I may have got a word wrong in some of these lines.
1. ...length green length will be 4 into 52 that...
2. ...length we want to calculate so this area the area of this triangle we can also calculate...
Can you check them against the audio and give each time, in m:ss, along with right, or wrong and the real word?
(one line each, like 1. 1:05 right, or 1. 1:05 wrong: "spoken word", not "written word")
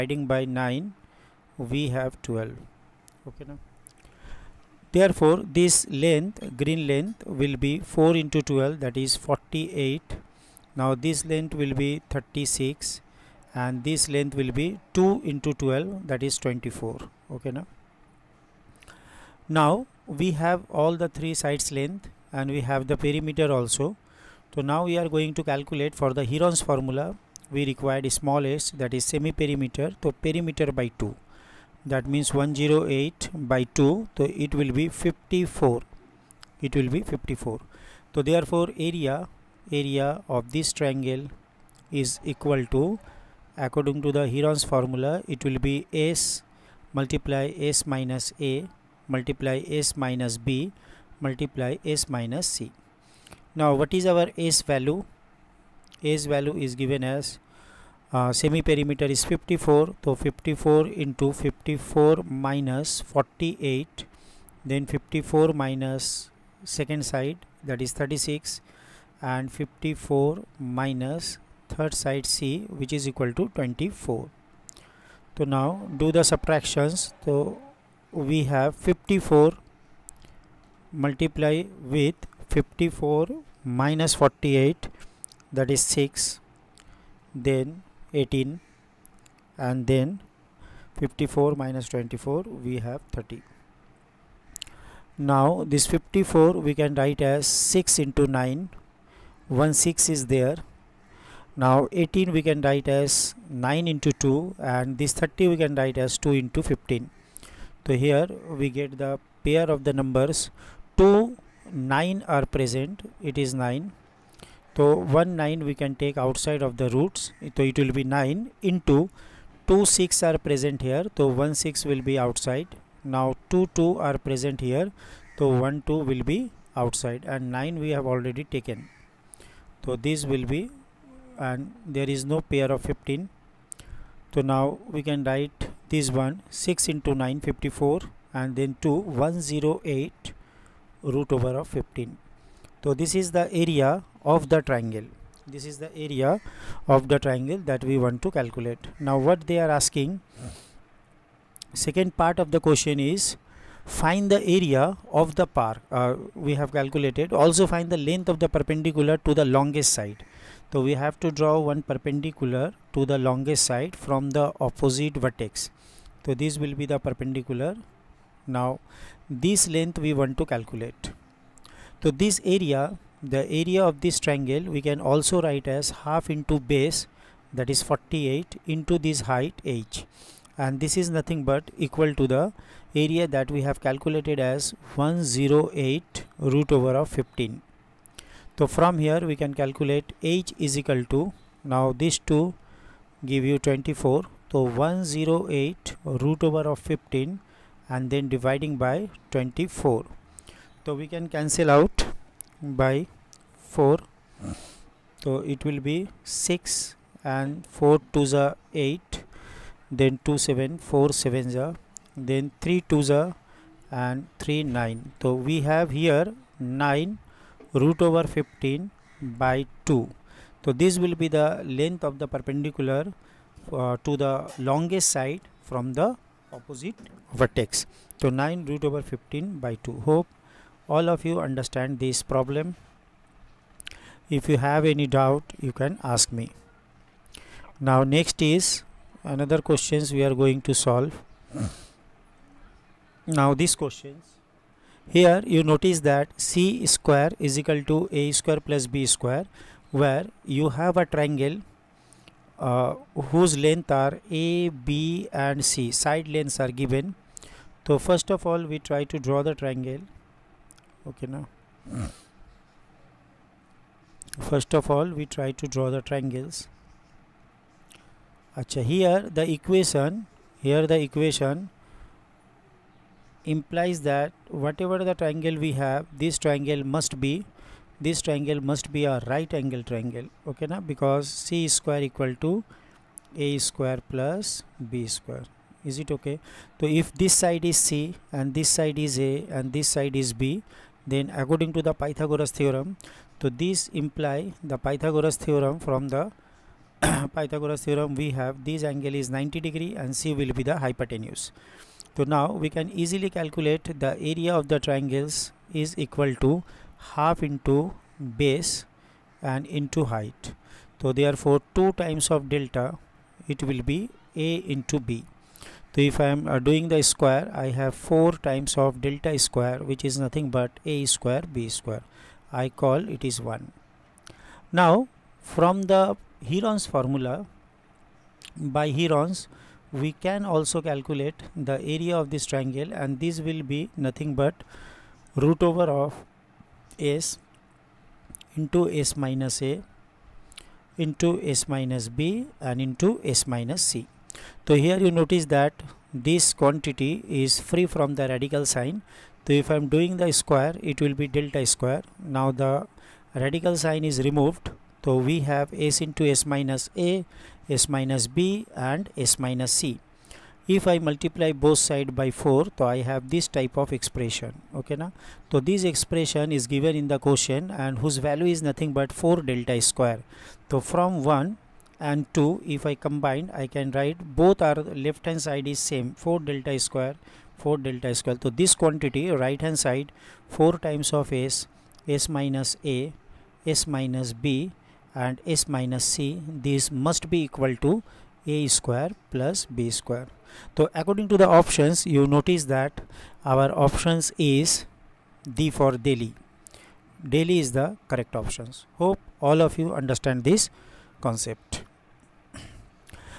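1. 0:05 wrong: "12", not "52"
2. 2:49 wrong: "write", not "calculate".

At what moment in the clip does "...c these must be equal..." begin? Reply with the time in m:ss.
6:26.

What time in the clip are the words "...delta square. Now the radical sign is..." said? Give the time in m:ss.
5:51.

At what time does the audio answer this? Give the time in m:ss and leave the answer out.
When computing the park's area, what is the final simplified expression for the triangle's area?
2:19.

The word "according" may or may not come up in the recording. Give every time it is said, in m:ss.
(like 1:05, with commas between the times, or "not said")
0:43, 4:51, 6:31.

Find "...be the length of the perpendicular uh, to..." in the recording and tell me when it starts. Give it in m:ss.
3:41.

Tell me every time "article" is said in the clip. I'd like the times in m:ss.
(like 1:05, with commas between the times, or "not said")
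not said.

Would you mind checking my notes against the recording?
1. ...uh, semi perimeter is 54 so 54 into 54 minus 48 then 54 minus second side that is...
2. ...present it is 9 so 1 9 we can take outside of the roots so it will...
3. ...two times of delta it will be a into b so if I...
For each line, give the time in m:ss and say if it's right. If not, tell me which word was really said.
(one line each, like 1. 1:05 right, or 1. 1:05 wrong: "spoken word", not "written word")
1. 0:58 right
2. 1:52 right
3. 5:11 right.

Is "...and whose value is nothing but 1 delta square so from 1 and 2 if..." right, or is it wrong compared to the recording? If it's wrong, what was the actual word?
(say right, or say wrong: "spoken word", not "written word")
wrong: "4", not "1".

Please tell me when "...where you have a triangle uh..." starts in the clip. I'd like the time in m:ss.
4:09.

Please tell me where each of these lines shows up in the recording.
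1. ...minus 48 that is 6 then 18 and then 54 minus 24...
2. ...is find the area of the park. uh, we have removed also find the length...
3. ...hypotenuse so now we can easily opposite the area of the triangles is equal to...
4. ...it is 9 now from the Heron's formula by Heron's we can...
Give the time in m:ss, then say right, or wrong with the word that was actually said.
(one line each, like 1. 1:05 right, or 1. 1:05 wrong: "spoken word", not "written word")
1. 1:23 right
2. 2:32 wrong: "calculated", not "removed"
3. 5:00 wrong: "calculate", not "opposite"
4. 5:23 wrong: "1", not "9".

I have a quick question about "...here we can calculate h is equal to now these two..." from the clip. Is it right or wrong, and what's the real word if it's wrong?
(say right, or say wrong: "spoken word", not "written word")
right.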